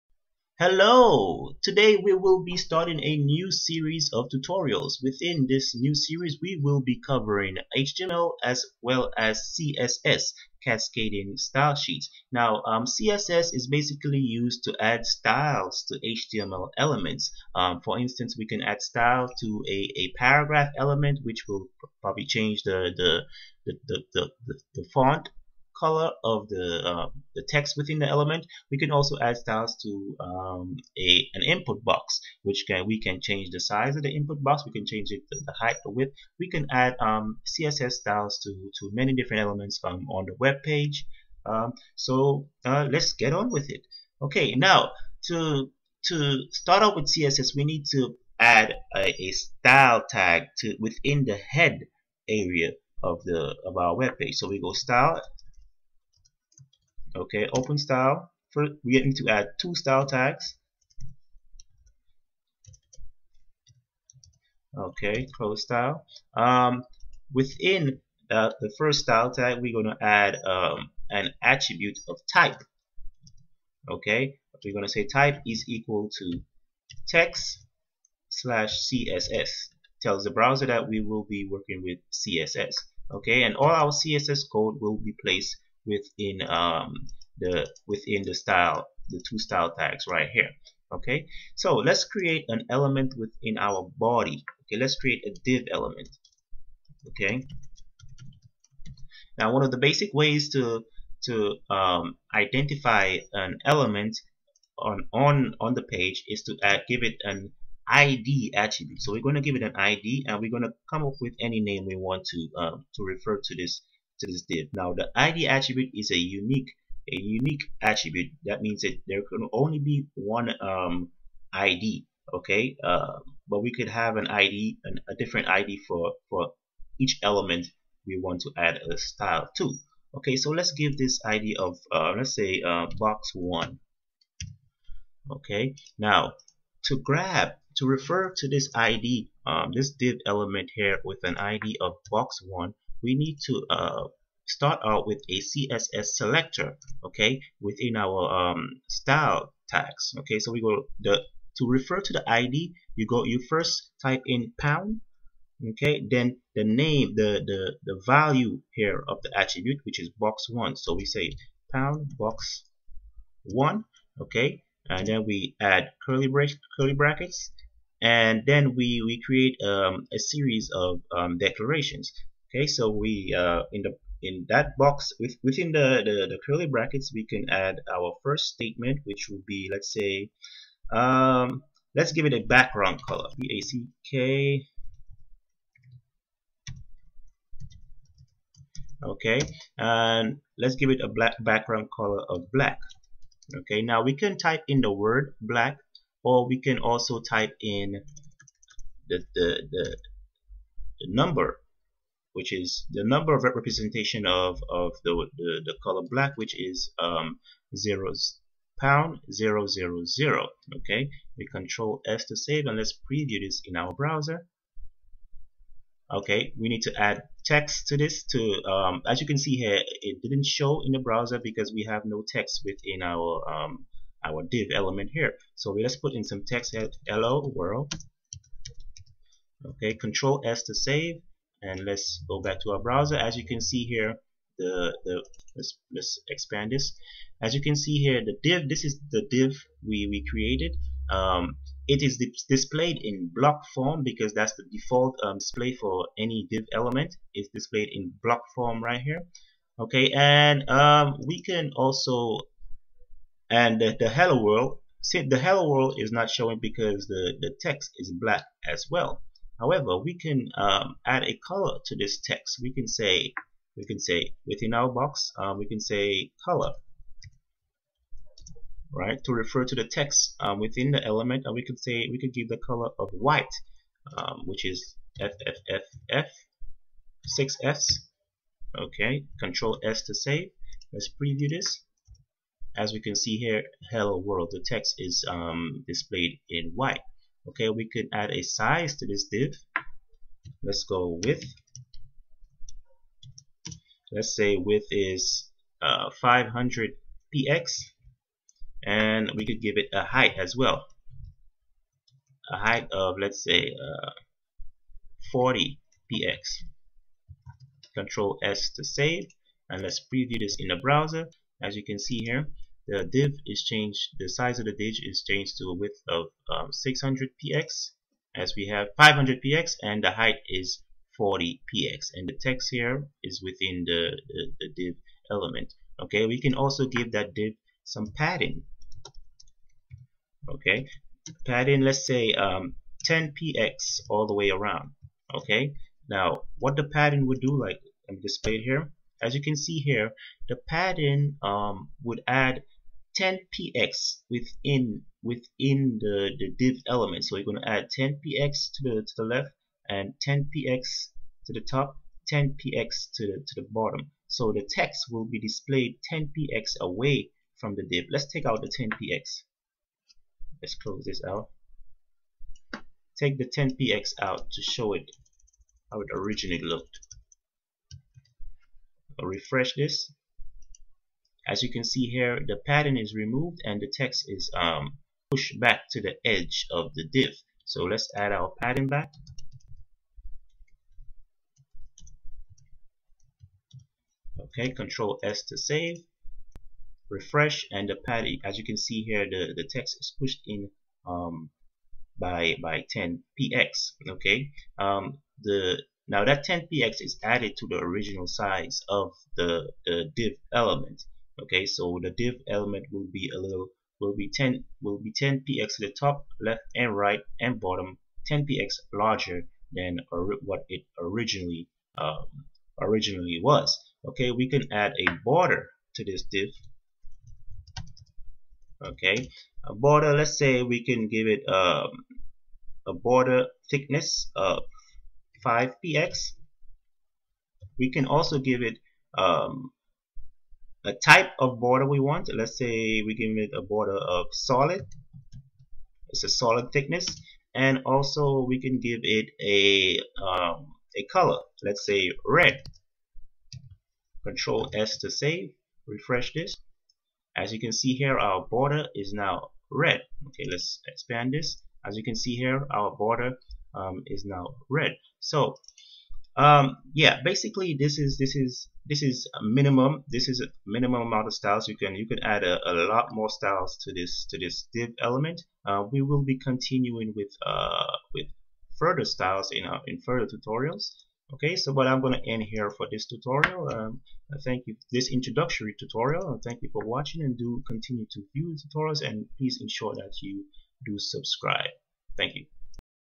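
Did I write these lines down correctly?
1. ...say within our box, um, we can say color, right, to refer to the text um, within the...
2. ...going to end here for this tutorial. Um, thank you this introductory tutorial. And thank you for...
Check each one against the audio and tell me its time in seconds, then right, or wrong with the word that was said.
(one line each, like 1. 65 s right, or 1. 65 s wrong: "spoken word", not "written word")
1. 263 s right
2. 472 s right.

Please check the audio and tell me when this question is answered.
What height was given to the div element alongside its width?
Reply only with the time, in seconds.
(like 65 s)
305 s.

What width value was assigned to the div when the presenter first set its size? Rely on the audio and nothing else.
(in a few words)
500 px.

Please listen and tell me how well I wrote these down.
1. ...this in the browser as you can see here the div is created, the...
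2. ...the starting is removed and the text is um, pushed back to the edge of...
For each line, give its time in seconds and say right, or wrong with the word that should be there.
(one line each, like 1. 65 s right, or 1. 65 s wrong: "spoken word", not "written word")
1. 310 s wrong: "changed", not "created"
2. 372 s wrong: "padding", not "starting".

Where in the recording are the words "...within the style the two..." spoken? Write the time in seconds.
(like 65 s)
87 s.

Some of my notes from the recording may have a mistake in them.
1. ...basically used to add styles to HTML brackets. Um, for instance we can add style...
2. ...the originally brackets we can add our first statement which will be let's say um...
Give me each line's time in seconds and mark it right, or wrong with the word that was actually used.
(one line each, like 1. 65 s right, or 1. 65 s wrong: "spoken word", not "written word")
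1. 13 s wrong: "elements", not "brackets"
2. 176 s wrong: "curly", not "originally".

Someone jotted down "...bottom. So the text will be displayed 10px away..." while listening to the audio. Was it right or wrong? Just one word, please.
right.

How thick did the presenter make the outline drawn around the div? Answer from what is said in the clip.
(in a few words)
5 px.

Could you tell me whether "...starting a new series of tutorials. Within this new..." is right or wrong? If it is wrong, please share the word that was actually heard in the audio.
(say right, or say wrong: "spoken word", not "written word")
right.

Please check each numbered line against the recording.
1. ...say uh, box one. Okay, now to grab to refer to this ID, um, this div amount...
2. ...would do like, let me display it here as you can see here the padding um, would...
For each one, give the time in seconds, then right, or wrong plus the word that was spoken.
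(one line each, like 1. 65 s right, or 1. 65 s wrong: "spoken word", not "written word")
1. 132 s wrong: "element", not "amount"
2. 337 s right.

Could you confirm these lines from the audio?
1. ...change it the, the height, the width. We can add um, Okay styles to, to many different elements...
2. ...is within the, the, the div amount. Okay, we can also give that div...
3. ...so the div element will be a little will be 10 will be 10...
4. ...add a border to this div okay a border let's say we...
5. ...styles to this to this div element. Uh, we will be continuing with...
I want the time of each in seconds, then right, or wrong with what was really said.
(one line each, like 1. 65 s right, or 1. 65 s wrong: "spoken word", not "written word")
1. 34 s wrong: "CSS", not "Okay"
2. 323 s wrong: "element", not "amount"
3. 401 s right
4. 414 s right
5. 463 s right.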